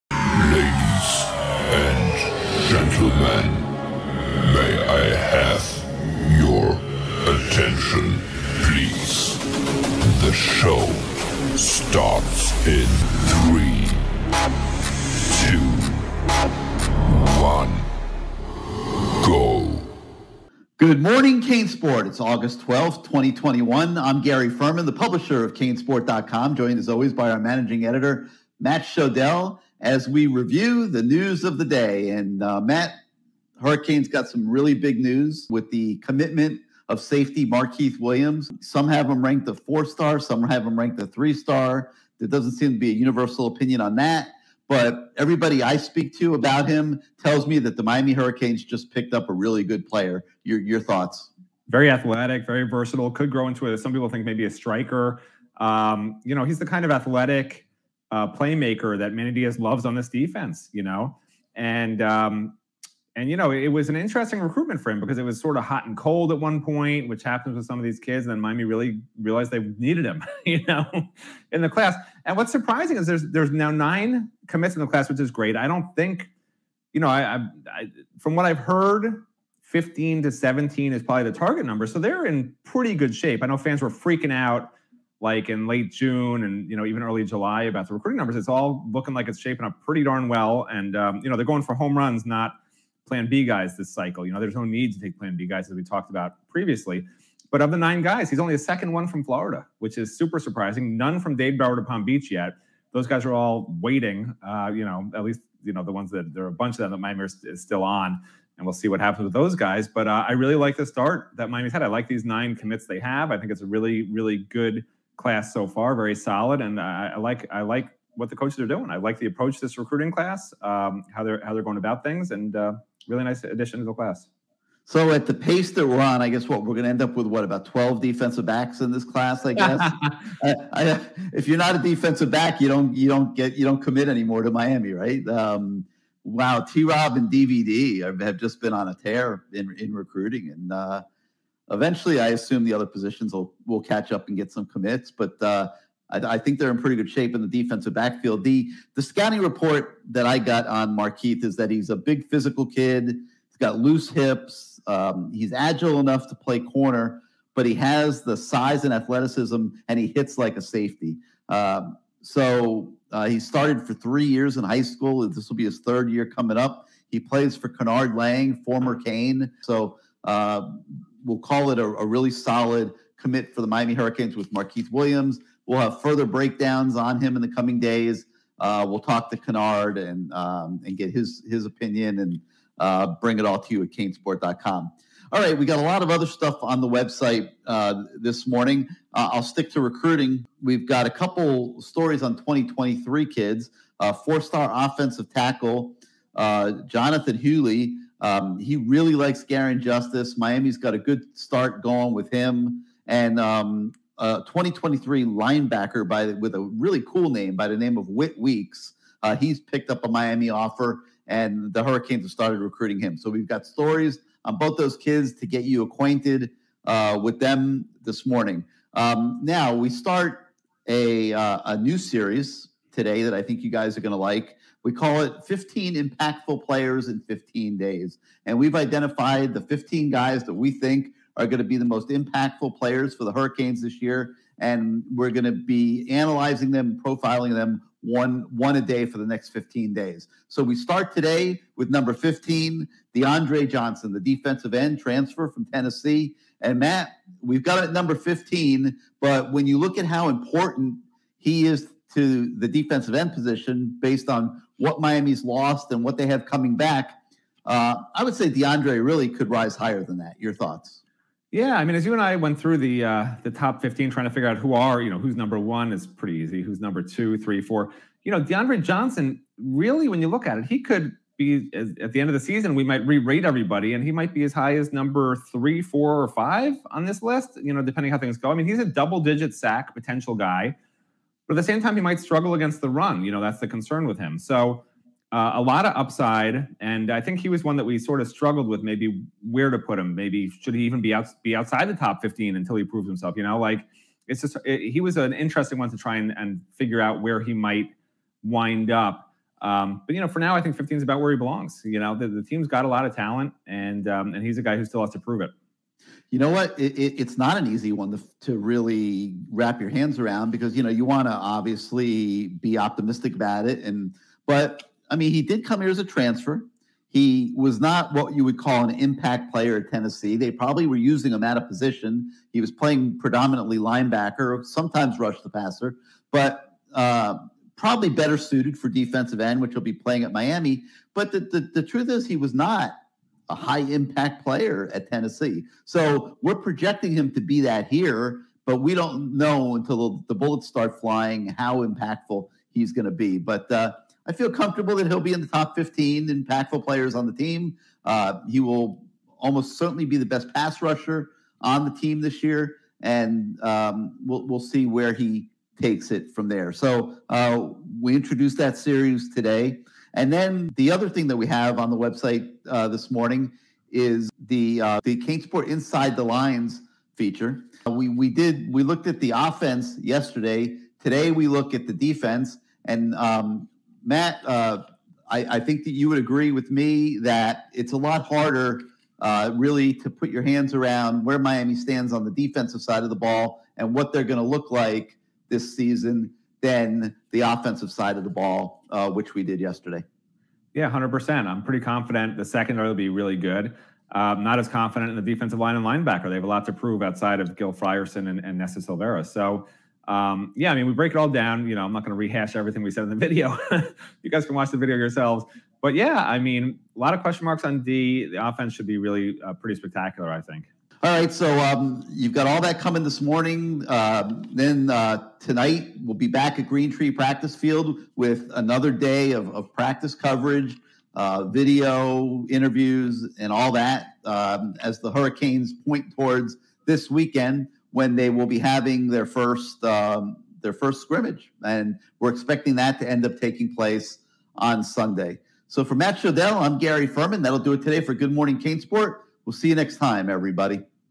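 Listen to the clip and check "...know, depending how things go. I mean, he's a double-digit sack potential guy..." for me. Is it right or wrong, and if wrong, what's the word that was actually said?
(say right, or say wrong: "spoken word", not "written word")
right.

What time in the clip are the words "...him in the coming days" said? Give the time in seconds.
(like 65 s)
177 s.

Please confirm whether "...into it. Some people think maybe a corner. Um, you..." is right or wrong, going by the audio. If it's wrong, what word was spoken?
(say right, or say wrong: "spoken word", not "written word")
wrong: "striker", not "corner".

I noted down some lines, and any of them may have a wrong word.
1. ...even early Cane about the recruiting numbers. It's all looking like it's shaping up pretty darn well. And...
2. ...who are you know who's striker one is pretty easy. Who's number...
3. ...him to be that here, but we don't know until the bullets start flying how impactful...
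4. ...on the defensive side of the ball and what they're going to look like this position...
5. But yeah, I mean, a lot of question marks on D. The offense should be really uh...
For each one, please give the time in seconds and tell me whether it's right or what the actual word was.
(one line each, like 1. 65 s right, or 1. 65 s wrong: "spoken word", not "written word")
1. 86 s wrong: "July", not "Cane"
2. 264 s wrong: "number", not "striker"
3. 337 s right
4. 382 s wrong: "season", not "position"
5. 405 s right.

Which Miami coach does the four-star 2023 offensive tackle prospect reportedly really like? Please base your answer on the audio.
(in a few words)
Garin Justice.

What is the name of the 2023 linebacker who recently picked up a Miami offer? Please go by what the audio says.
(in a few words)
Whit Weeks.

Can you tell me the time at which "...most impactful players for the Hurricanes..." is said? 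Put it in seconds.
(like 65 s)
231 s.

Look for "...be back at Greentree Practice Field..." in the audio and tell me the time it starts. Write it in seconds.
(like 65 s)
416 s.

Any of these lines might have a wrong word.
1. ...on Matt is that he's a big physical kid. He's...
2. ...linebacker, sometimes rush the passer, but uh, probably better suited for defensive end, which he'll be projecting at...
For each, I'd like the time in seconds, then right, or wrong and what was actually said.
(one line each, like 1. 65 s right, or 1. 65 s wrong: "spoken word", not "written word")
1. 150 s wrong: "Markeith", not "Matt"
2. 323 s wrong: "playing", not "projecting".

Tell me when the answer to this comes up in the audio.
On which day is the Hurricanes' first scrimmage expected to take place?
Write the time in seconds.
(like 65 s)
434 s.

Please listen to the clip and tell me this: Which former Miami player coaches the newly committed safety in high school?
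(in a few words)
Kennard Lang.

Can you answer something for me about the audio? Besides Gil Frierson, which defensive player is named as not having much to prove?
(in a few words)
Nesta Silvera.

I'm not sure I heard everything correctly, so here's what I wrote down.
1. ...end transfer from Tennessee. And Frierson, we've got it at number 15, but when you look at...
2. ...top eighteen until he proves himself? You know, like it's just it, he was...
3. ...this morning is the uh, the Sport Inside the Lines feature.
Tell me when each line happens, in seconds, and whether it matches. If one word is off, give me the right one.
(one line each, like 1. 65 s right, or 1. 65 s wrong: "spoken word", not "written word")
1. 244 s wrong: "Matt", not "Frierson"
2. 291 s wrong: "fifteen", not "eighteen"
3. 362 s right.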